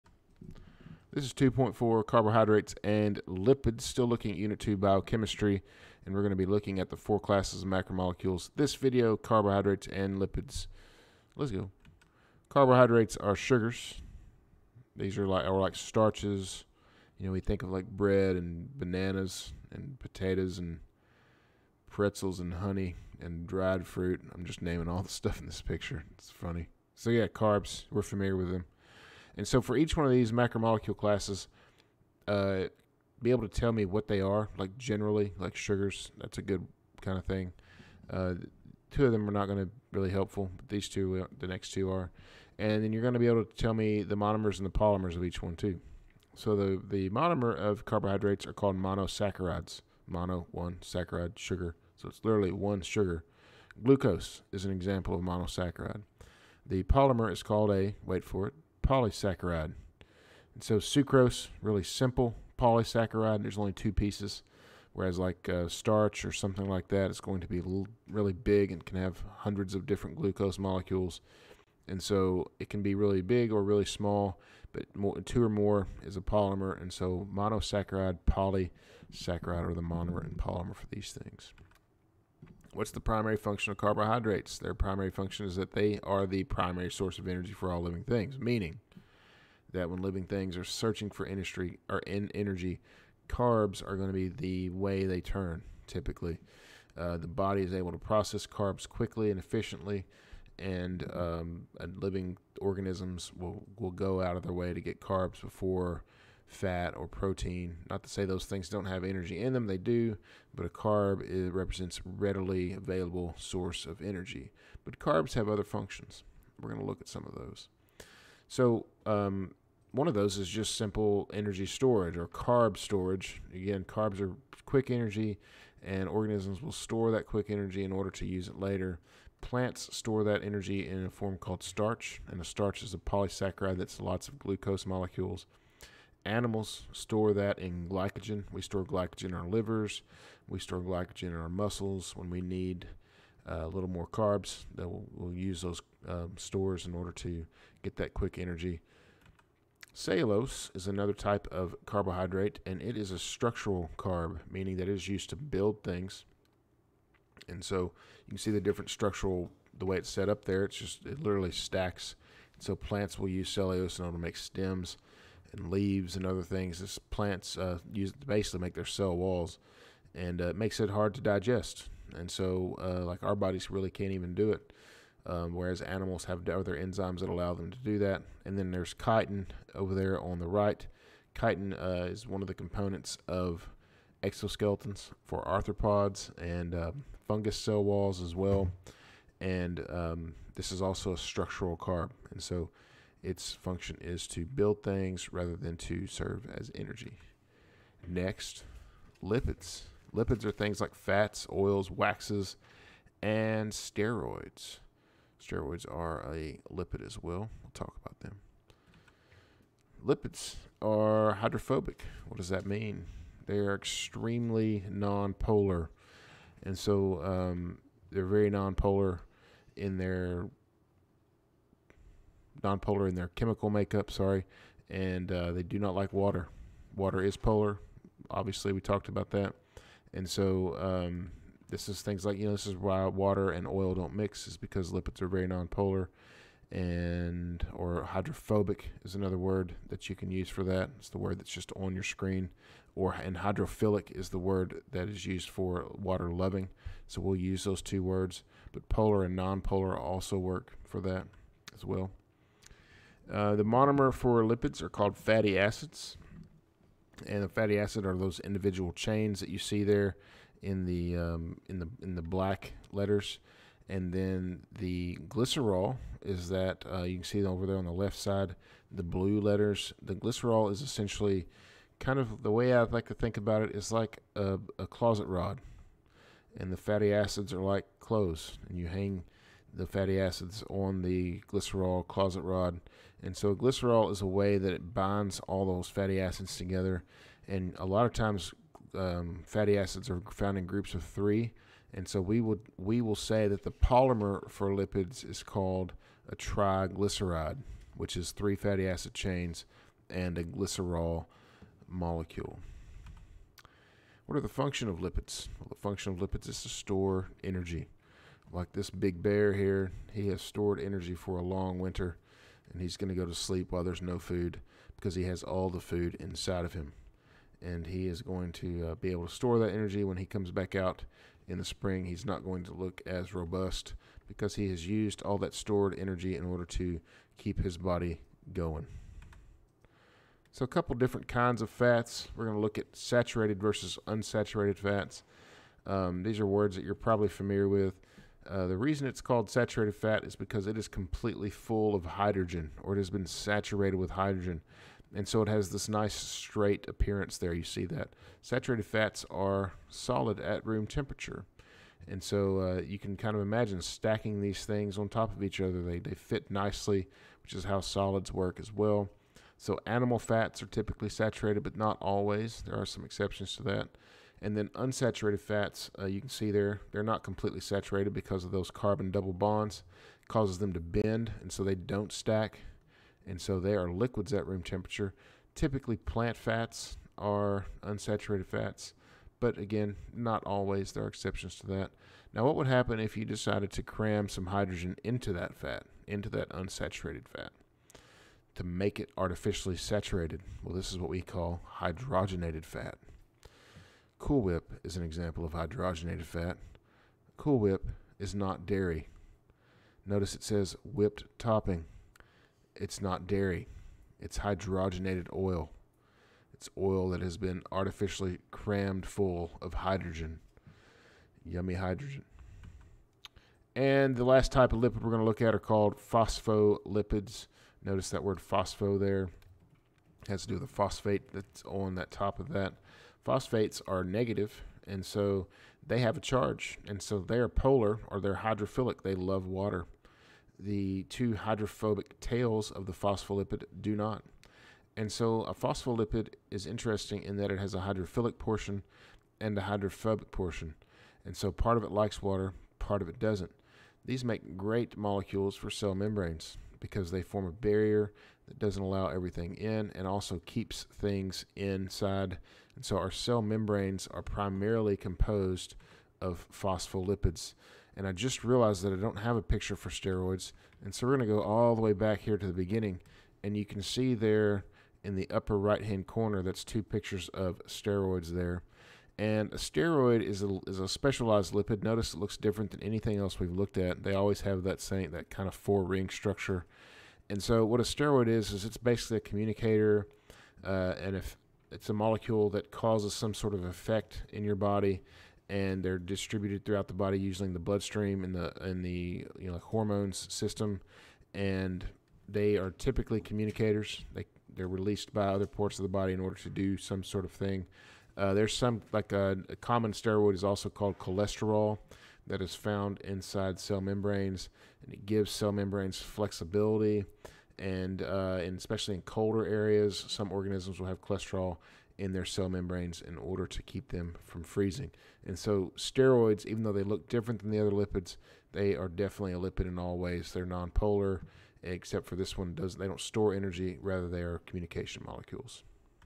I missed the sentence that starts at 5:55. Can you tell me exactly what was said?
They, they fit nicely, which is how solids work as well.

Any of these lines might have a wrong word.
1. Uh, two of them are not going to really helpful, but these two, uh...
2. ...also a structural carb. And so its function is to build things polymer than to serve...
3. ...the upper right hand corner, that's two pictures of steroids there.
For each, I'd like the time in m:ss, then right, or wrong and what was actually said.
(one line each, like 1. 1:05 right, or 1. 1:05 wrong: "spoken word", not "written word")
1. 0:38 right
2. 3:10 wrong: "rather", not "polymer"
3. 7:45 right.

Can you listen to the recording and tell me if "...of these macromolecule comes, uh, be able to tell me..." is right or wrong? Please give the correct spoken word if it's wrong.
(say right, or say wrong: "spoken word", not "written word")
wrong: "classes", not "comes".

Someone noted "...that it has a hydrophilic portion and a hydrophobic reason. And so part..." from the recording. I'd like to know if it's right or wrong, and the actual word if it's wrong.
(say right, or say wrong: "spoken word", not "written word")
wrong: "portion", not "reason".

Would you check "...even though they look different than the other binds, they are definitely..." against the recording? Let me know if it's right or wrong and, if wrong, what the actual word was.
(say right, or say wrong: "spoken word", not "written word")
wrong: "lipids", not "binds".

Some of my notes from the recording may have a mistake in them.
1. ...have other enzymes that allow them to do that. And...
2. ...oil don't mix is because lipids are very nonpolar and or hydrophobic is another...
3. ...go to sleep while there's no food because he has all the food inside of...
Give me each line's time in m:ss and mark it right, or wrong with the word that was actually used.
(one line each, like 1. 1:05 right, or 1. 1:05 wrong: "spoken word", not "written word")
1. 2:56 right
2. 3:53 right
3. 5:13 right.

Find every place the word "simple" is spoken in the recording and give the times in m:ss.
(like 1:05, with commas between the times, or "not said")
1:01, 2:00.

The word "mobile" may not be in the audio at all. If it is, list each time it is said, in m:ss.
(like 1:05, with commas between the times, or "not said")
not said.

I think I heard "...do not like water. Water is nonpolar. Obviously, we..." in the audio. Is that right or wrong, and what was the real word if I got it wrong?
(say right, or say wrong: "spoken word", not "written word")
wrong: "polar", not "nonpolar".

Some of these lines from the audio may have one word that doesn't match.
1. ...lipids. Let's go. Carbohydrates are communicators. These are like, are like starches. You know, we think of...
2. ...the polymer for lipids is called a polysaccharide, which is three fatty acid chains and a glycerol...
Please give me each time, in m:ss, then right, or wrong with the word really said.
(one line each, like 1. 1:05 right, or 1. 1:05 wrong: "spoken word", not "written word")
1. 0:10 wrong: "sugars", not "communicators"
2. 4:53 wrong: "triglyceride", not "polysaccharide".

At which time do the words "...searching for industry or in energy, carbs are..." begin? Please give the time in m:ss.
1:30.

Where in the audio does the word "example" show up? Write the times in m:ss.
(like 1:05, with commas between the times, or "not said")
0:54, 6:35.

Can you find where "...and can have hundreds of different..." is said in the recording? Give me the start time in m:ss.
1:08.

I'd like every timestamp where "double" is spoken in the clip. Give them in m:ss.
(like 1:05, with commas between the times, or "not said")
6:09.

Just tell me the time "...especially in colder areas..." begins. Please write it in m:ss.
8:28.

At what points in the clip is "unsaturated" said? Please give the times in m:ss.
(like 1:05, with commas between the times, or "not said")
5:34, 6:04, 6:17, 6:26.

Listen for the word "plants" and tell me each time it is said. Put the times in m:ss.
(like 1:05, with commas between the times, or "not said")
2:09, 2:42, 2:46, 6:15.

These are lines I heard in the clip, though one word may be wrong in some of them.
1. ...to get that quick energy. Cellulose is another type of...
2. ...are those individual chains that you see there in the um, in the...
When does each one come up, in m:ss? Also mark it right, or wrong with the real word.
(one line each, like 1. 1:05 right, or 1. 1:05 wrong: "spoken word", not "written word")
1. 2:27 right
2. 4:18 right.